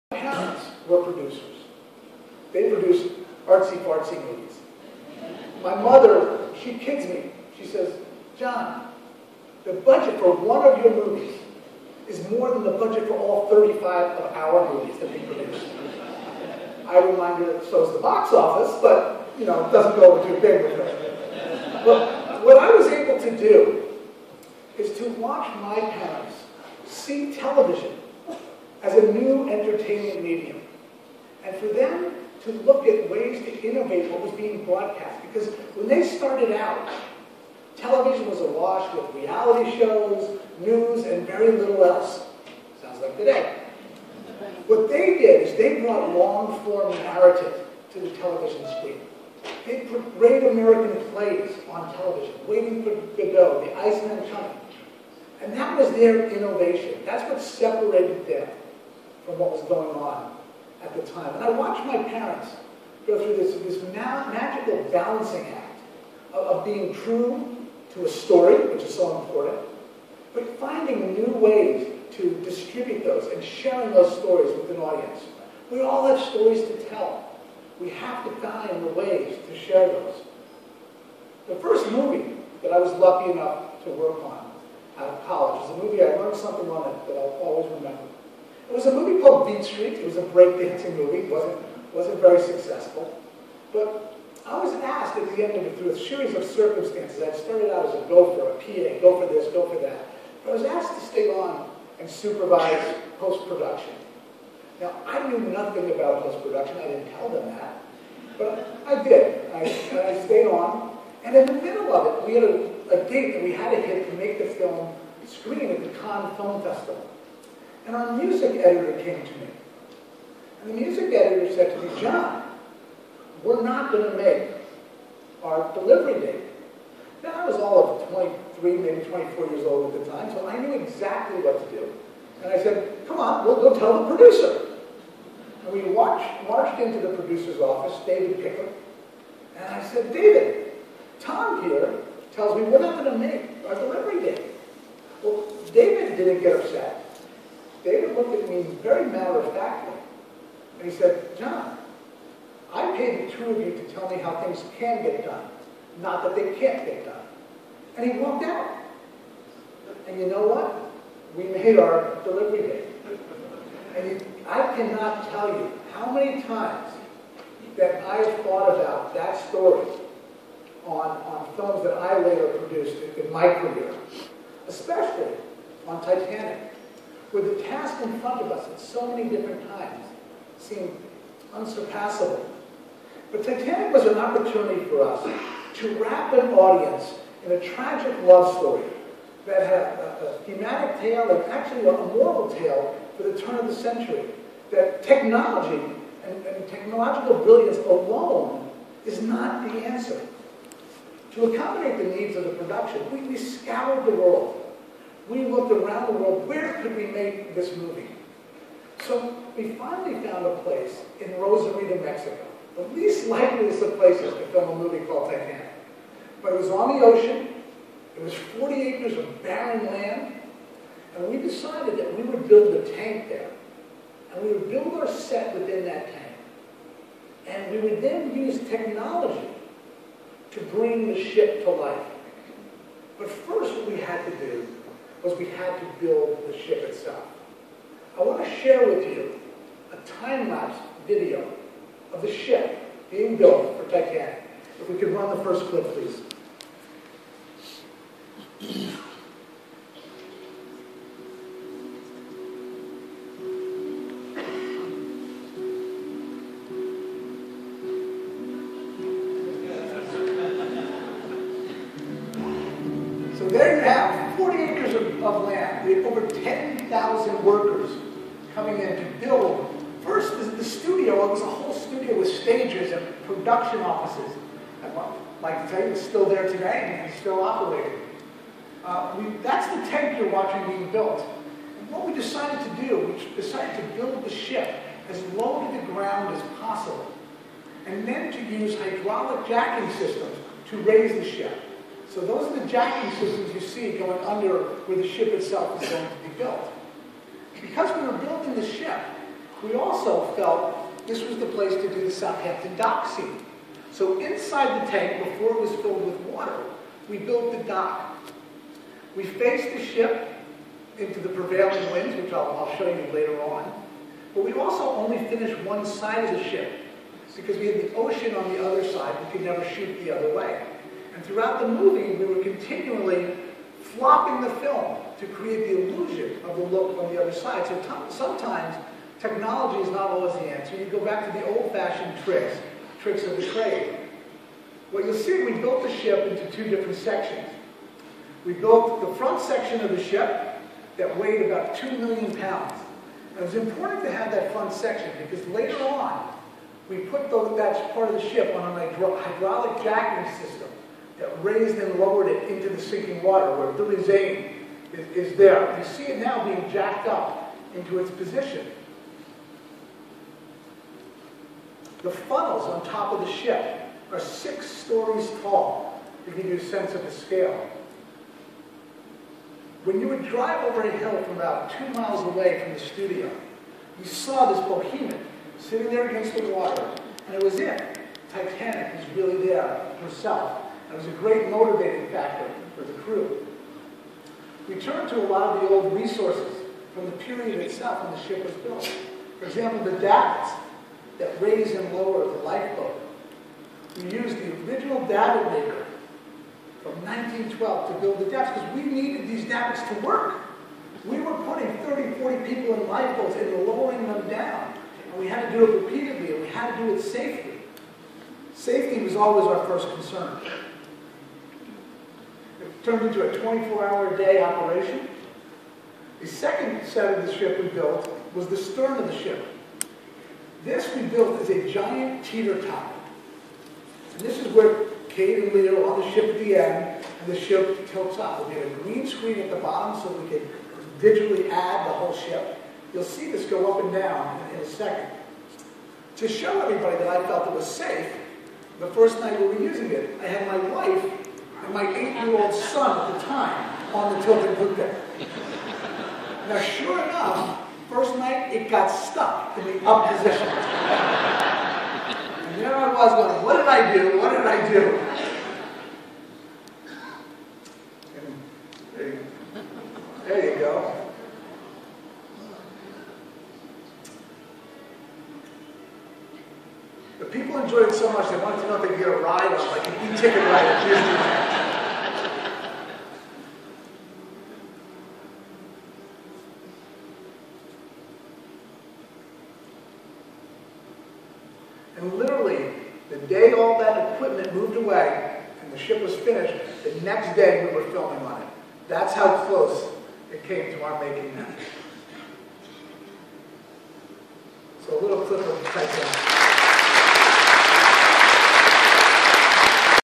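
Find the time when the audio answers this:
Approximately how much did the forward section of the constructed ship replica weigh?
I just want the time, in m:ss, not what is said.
5:41.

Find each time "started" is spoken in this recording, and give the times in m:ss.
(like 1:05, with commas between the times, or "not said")
0:36, 1:37.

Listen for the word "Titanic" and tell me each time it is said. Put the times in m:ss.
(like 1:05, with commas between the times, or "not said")
2:56, 3:03, 3:35, 4:03, 6:18, 8:15.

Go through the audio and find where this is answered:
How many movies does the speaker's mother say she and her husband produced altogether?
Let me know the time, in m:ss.
0:13.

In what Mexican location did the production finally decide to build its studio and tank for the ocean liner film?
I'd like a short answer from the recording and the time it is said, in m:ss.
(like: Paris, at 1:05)
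Rosarito, Mexico, at 3:31.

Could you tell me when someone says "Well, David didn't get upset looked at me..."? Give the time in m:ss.
2:25.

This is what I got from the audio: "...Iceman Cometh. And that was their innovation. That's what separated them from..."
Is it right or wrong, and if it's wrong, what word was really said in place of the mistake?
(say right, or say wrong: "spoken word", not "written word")
right.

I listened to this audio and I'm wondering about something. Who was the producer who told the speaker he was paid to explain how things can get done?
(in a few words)
David Picker.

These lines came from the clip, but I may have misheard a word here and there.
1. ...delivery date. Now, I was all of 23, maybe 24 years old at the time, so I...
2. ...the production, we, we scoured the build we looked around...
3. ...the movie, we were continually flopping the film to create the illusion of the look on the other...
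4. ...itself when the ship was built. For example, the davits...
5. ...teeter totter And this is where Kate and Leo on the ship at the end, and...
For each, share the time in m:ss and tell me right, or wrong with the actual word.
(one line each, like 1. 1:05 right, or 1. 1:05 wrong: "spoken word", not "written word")
1. 2:05 right
2. 3:22 wrong: "world", not "build"
3. 5:21 right
4. 6:27 right
5. 7:02 right.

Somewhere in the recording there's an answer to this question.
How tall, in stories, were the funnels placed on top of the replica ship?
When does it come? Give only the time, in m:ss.
6:04.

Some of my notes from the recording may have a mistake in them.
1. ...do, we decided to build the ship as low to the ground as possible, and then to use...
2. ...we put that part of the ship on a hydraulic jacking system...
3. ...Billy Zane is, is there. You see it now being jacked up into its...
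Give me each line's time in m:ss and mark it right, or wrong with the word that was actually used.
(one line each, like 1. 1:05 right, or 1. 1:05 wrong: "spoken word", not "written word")
1. 4:42 right
2. 5:46 right
3. 5:53 right.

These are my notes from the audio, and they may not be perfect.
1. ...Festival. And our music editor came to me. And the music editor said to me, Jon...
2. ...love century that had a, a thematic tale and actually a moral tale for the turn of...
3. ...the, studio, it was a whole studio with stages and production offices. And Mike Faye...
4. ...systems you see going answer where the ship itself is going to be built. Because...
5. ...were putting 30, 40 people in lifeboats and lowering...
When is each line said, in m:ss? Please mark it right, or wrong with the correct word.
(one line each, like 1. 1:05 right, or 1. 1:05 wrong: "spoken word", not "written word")
1. 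1:56 right
2. 3:08 wrong: "story", not "century"
3. 4:30 right
4. 4:53 wrong: "under", not "answer"
5. 6:41 right.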